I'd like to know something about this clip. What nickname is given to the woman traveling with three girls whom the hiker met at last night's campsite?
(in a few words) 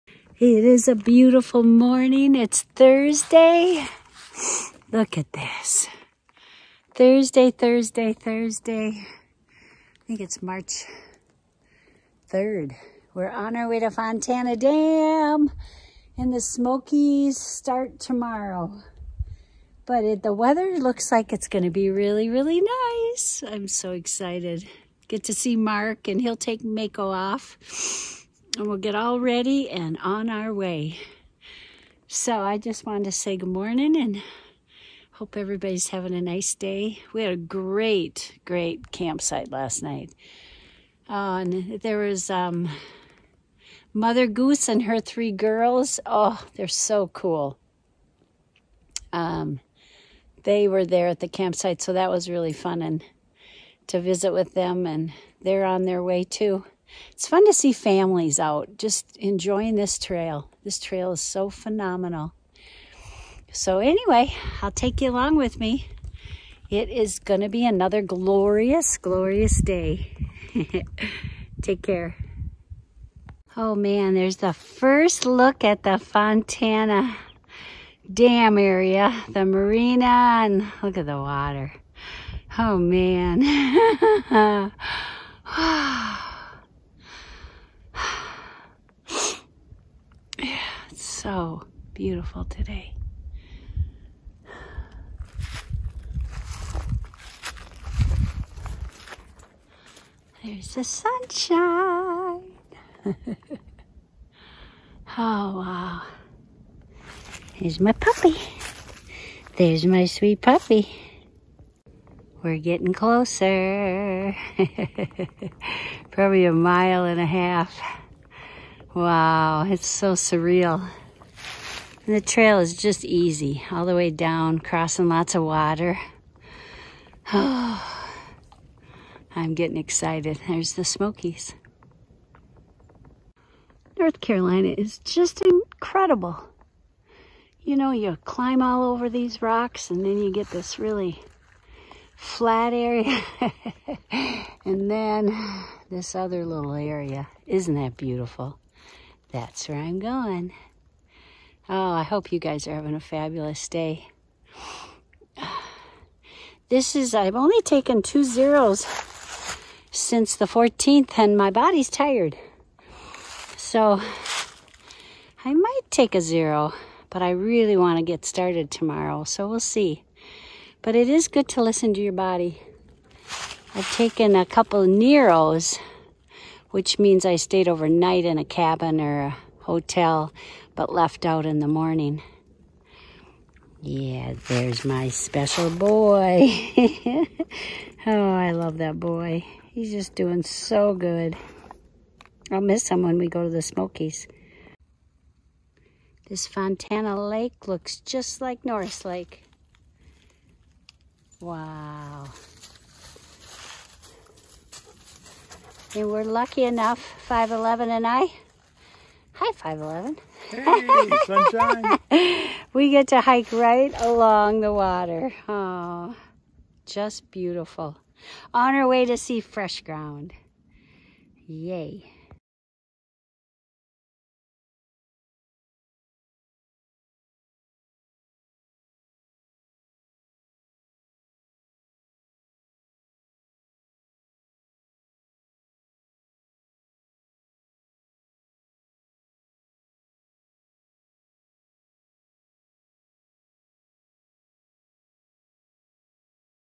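Mother Goose.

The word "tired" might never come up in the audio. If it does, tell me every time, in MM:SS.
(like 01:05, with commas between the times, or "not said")
02:41.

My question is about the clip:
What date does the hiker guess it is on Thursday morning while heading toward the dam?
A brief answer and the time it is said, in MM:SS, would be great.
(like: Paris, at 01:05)
March 3rd, at 00:10.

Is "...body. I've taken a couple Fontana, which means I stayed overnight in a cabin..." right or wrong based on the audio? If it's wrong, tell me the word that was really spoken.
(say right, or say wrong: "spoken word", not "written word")
wrong: "Neros", not "Fontana".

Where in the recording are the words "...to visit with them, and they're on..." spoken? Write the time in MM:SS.
00:53.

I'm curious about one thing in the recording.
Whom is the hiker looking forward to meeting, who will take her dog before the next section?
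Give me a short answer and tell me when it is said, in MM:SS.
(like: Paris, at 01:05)
Mark, at 00:25.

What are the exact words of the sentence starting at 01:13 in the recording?
Oh man, there's the first look at the Fontana Dam area, the marina, and look at the water.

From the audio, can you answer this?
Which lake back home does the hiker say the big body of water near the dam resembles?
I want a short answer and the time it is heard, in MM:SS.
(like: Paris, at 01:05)
Norris Lake, at 03:18.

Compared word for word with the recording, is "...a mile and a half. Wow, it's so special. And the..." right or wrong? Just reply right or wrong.
wrong.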